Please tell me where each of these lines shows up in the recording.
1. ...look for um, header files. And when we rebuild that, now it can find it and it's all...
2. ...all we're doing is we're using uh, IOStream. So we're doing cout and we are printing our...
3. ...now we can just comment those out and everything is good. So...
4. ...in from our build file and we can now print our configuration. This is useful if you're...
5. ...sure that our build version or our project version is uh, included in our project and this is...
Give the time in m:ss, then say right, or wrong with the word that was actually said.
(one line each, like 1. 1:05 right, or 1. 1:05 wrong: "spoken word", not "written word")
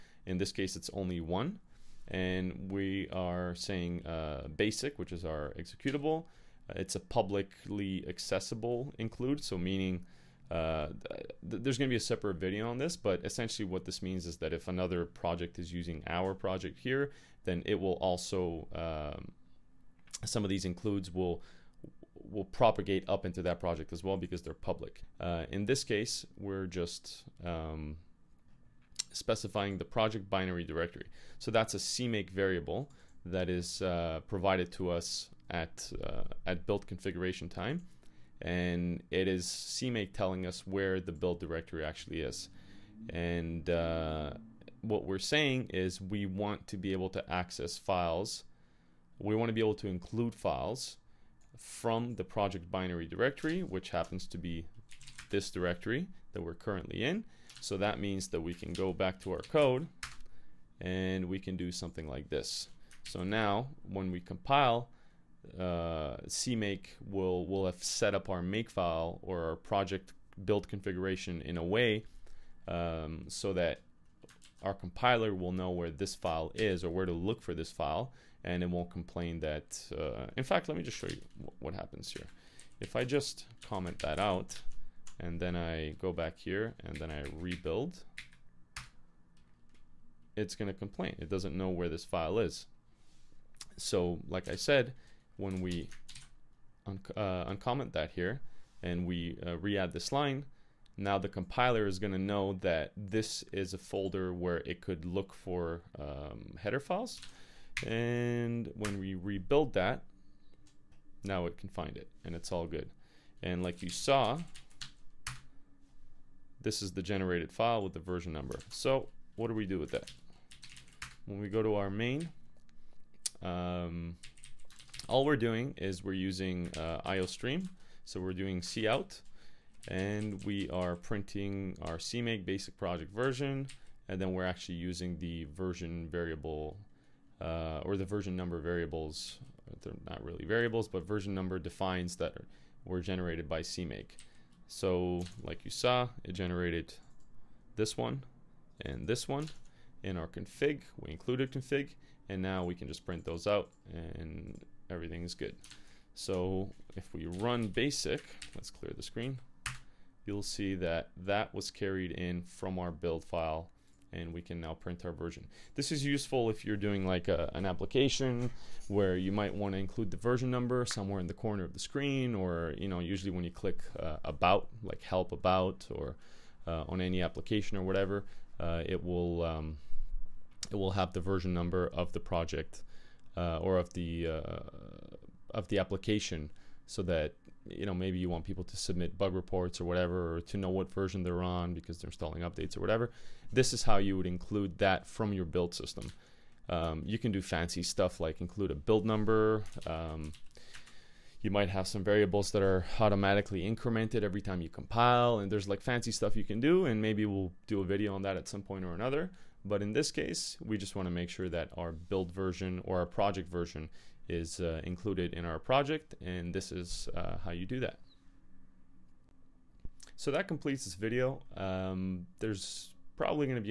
1. 1:45 right
2. 2:05 right
3. 2:32 wrong: "print", not "comment"
4. 2:42 wrong: "version", not "configuration"
5. 3:31 right.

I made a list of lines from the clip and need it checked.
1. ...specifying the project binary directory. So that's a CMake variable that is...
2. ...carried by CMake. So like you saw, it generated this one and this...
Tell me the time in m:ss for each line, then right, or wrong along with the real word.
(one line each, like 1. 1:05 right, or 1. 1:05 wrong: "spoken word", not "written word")
1. 0:29 right
2. 2:23 wrong: "generated", not "carried".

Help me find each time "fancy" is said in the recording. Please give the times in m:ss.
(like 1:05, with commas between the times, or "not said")
3:17, 3:25.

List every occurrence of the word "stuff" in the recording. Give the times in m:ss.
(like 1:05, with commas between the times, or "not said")
3:17, 3:26.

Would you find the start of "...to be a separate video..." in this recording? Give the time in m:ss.
0:11.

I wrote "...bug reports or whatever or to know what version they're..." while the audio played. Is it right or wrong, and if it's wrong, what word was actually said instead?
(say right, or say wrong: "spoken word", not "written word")
right.